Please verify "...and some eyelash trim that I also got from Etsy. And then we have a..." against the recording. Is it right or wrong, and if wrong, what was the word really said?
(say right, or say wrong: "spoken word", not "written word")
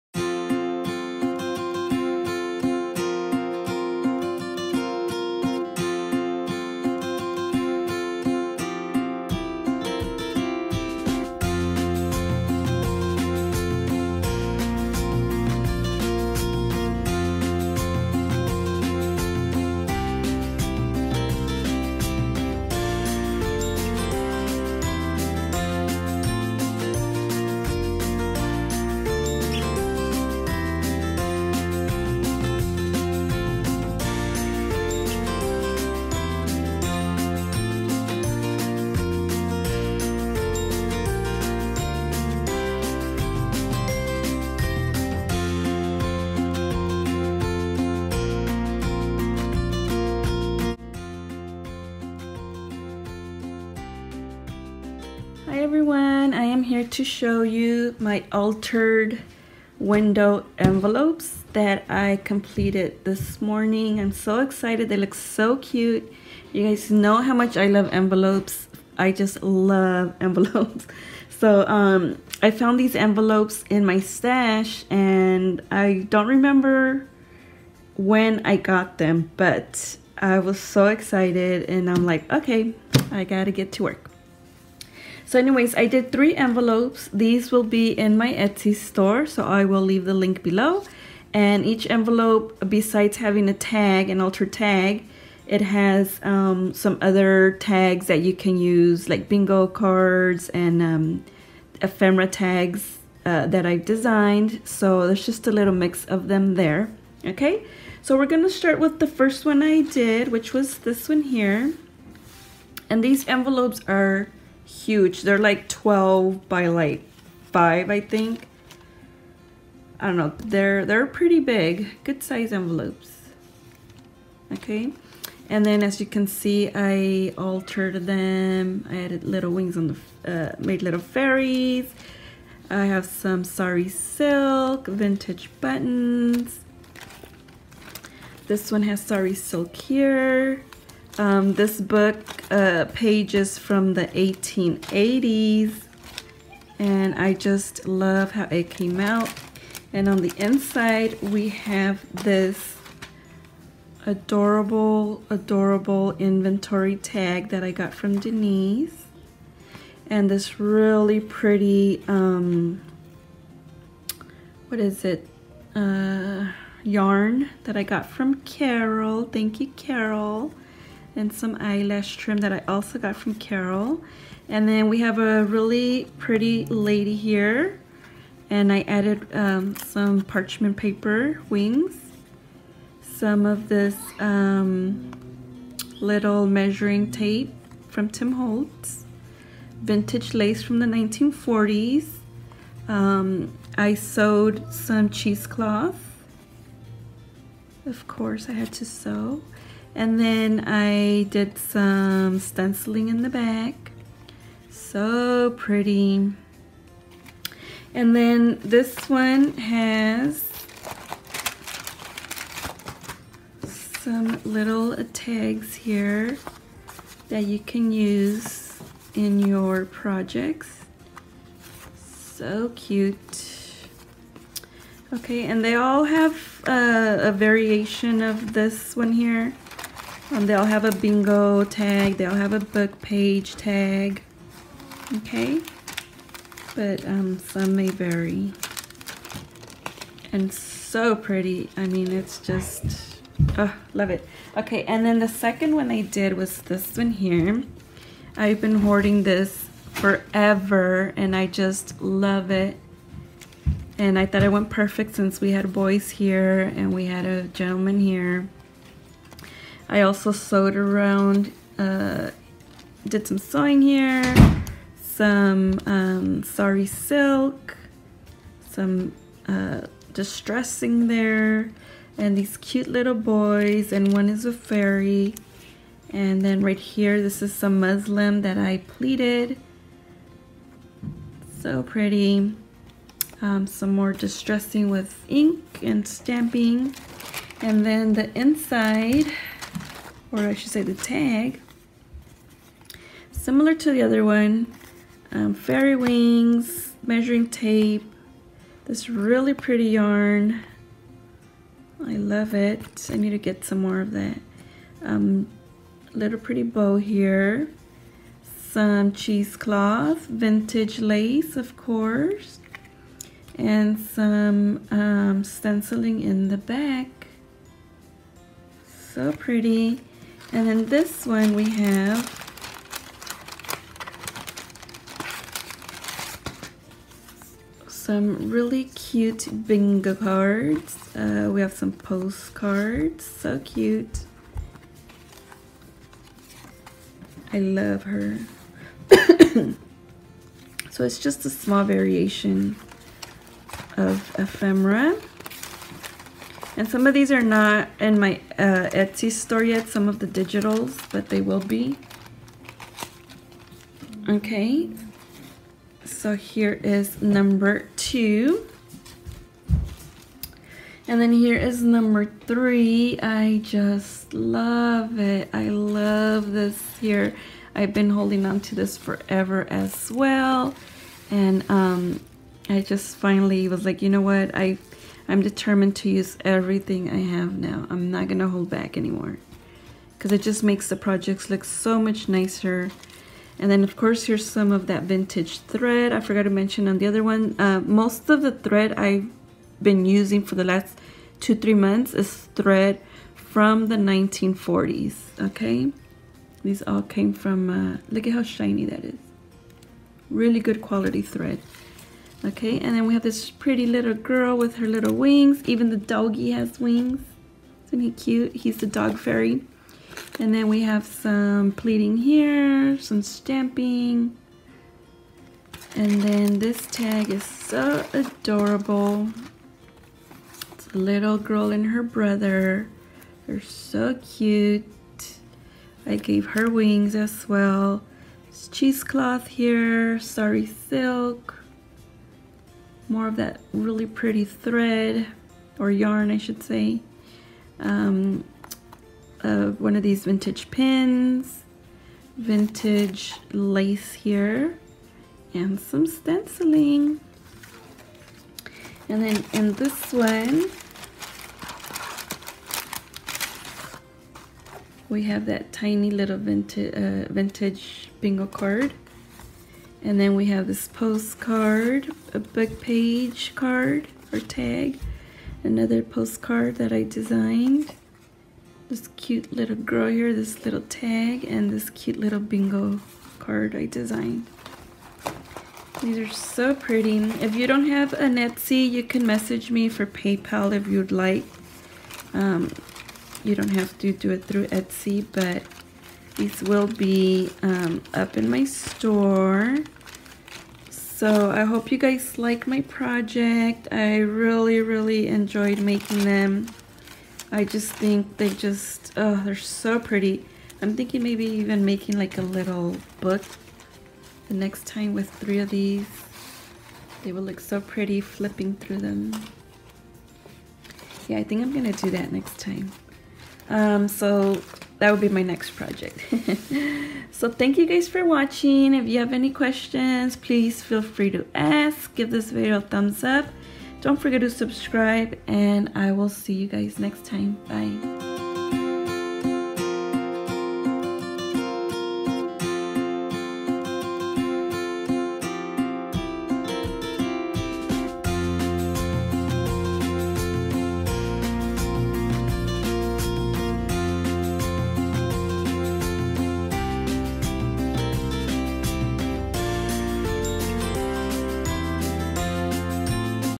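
wrong: "Carol", not "Etsy".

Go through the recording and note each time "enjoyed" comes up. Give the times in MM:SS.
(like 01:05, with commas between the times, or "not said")
08:15.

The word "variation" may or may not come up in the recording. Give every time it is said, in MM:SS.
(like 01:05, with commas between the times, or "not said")
03:47, 05:41.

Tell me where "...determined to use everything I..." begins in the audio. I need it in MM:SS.
06:15.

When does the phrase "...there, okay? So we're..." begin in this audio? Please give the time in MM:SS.
01:46.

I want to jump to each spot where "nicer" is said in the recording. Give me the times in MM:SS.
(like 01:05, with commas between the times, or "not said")
06:22.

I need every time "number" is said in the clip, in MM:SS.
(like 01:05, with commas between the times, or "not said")
05:57, 06:01.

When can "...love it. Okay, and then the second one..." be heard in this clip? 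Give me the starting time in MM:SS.
04:03.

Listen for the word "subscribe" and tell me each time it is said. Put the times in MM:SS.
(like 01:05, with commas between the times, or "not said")
08:44.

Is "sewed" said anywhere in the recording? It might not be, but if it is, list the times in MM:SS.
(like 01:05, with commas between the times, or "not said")
03:13, 04:20.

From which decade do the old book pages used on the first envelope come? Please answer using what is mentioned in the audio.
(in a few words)
1880s.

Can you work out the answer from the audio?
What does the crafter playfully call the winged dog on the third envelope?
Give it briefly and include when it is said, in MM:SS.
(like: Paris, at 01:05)
The dog fairy, at 06:48.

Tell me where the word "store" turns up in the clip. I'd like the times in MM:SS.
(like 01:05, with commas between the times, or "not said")
01:28, 05:49, 08:08.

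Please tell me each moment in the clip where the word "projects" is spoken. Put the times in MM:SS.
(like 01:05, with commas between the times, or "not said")
03:39, 06:20, 08:12, 08:35.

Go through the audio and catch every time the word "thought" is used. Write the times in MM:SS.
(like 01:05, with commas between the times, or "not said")
04:14.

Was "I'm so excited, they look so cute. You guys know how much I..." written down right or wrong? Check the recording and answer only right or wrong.
right.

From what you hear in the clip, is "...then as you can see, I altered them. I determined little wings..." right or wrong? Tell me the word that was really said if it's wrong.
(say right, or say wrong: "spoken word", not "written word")
wrong: "added", not "determined".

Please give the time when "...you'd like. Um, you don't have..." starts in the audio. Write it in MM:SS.
08:00.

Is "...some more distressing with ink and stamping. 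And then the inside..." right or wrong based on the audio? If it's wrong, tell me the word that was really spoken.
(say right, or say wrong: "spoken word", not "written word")
right.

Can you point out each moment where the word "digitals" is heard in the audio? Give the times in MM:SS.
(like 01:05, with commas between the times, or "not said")
05:50.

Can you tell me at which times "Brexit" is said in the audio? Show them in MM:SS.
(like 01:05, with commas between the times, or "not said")
not said.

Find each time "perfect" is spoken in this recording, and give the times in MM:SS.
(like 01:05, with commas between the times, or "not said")
04:14.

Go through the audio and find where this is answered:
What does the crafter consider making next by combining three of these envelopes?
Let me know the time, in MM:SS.
08:22.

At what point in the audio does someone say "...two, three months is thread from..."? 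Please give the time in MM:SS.
06:31.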